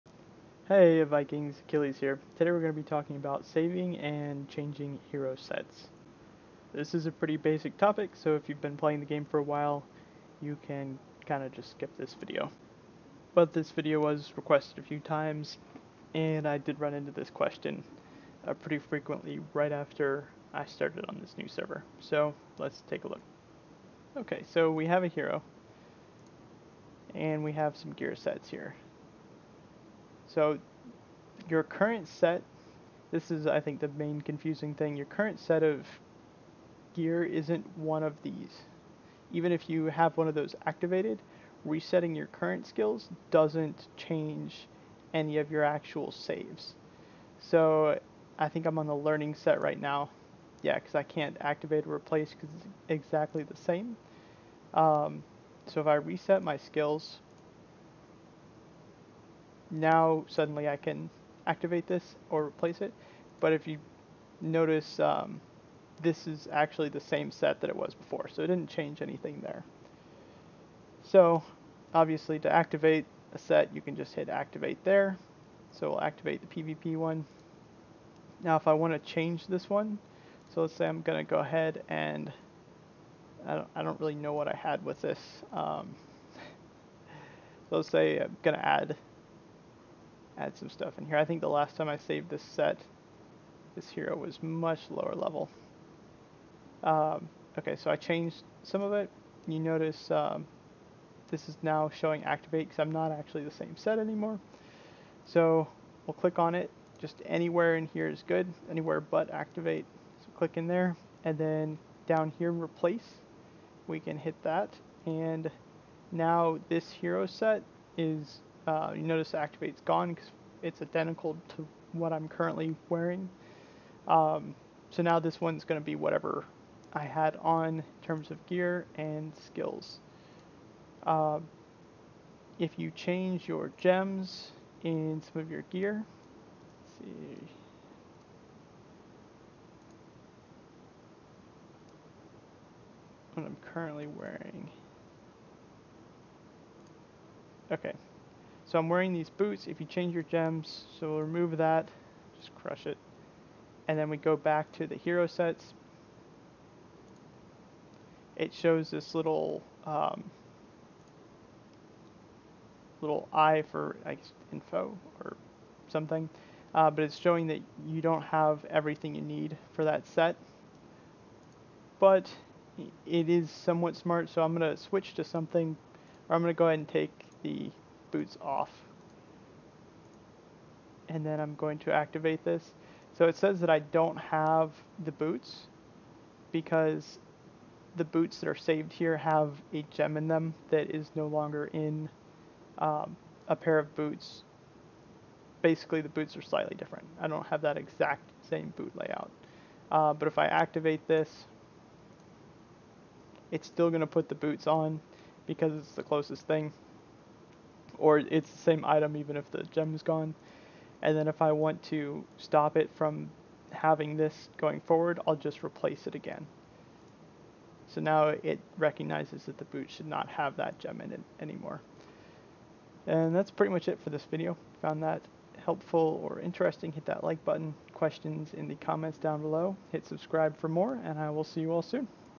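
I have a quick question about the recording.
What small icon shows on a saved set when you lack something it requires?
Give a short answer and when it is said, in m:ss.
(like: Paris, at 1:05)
little eye, at 2:43.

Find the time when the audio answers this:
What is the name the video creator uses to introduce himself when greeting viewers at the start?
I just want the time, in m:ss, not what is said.
0:01.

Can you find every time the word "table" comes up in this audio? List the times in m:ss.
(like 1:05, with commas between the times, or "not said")
not said.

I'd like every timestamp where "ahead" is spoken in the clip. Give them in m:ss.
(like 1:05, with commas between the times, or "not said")
1:21, 2:56.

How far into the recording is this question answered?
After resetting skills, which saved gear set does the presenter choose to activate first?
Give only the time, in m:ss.
1:16.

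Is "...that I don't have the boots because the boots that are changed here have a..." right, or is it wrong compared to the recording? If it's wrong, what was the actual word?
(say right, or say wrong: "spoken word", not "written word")
wrong: "saved", not "changed".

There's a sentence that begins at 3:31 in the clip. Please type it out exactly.
And then if I want to stop it from having this going forward, I'll just replace it again.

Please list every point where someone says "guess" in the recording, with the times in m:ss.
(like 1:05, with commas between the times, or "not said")
2:44.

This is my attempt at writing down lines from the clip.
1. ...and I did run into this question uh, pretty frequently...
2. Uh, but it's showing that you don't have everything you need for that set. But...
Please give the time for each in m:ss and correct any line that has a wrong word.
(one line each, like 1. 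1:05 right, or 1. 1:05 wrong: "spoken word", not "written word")
1. 0:16 right
2. 2:46 right.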